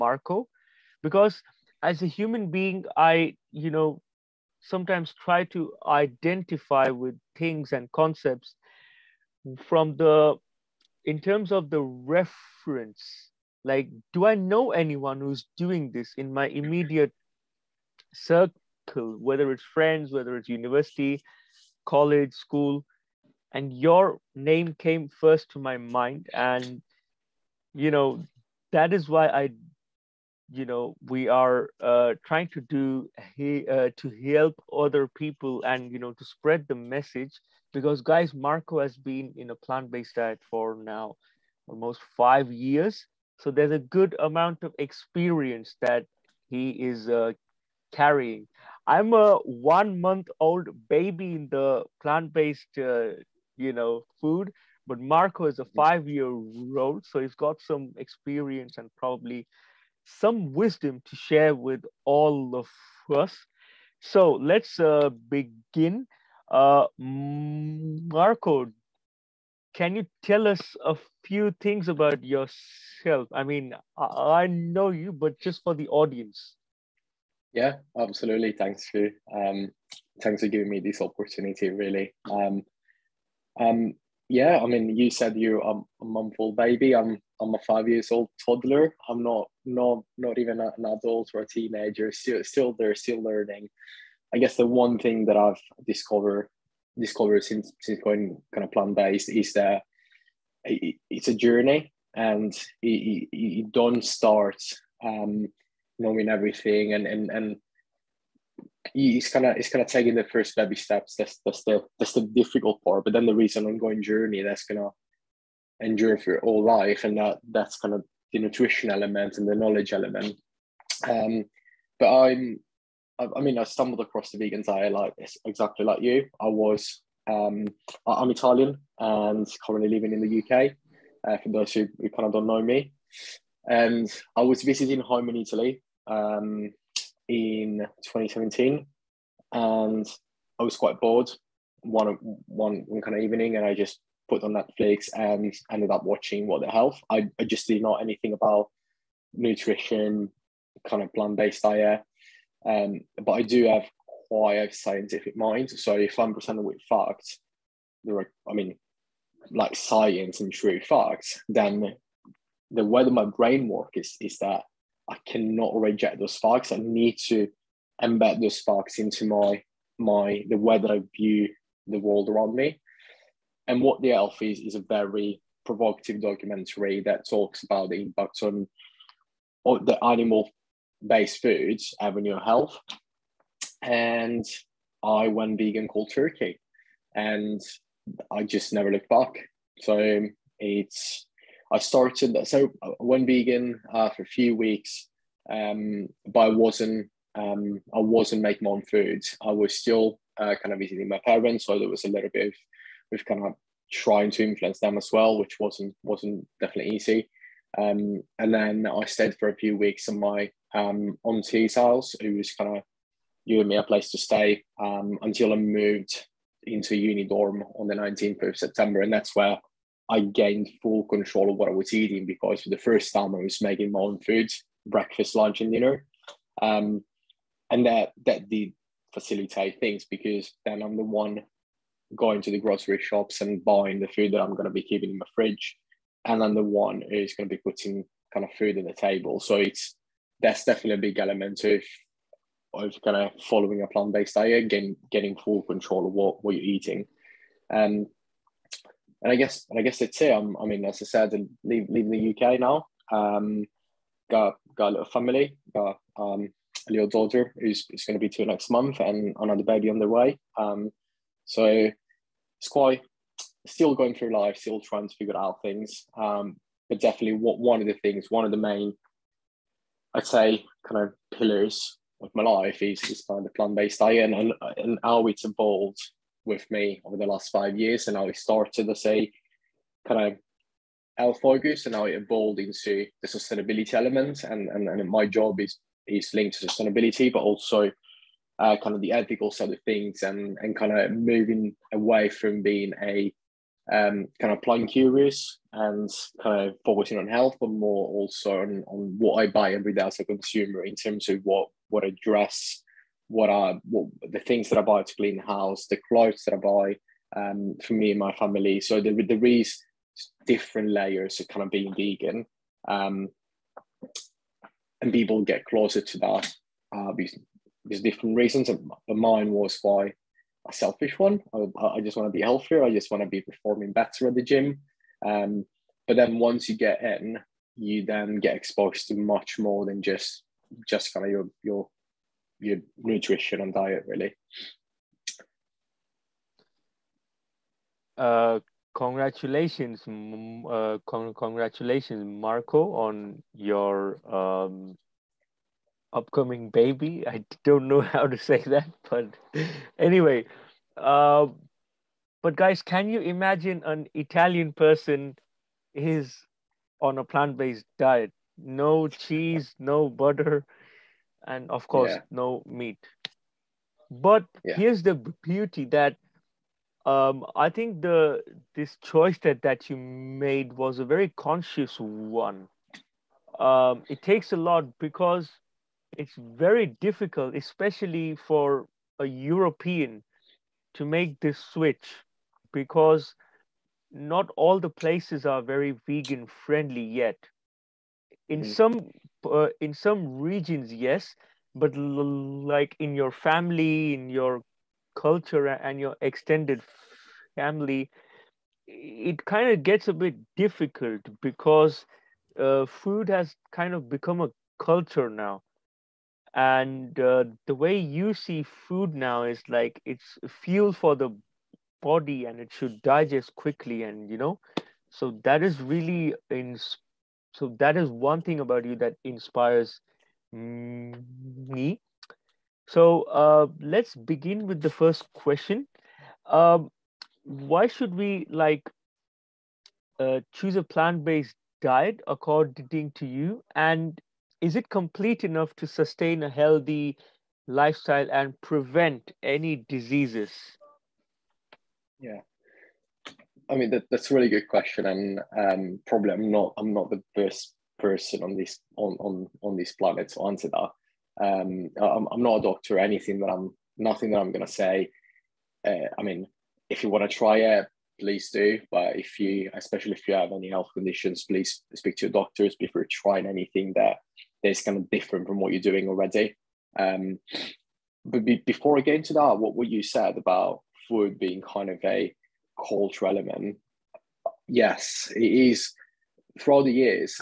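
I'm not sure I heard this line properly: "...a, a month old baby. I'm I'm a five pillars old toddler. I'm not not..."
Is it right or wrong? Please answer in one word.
wrong.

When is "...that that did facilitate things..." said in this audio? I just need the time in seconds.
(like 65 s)
227 s.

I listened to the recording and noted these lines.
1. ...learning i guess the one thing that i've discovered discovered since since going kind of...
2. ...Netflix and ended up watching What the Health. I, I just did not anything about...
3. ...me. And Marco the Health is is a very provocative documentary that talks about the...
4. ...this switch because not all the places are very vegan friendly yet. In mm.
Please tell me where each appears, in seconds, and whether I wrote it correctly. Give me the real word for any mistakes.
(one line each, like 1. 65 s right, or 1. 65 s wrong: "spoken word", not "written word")
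1. 93 s right
2. 144 s right
3. 172 s wrong: "What", not "Marco"
4. 381 s right.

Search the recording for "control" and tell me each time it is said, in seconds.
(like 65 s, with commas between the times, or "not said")
221 s, 245 s.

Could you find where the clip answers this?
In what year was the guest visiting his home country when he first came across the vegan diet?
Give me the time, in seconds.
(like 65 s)
138 s.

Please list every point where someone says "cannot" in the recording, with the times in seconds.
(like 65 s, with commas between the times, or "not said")
165 s.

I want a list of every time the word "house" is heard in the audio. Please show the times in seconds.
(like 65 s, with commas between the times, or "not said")
211 s, 305 s.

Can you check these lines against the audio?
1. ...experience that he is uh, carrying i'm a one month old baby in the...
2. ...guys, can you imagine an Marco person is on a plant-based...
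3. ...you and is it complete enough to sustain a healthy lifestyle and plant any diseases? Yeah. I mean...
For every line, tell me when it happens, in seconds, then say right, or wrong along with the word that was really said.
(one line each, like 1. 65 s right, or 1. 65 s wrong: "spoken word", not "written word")
1. 44 s right
2. 352 s wrong: "Italian", not "Marco"
3. 433 s wrong: "prevent", not "plant".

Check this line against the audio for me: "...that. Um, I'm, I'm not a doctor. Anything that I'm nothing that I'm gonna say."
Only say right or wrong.
right.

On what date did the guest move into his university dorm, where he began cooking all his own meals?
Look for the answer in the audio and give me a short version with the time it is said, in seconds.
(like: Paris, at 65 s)
19th of September, at 217 s.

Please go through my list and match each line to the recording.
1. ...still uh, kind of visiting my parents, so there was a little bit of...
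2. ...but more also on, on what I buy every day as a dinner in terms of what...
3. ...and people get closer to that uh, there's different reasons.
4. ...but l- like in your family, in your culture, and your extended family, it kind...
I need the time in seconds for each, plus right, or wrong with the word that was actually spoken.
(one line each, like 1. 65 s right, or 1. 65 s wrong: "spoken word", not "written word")
1. 199 s right
2. 297 s wrong: "consumer", not "dinner"
3. 315 s right
4. 391 s right.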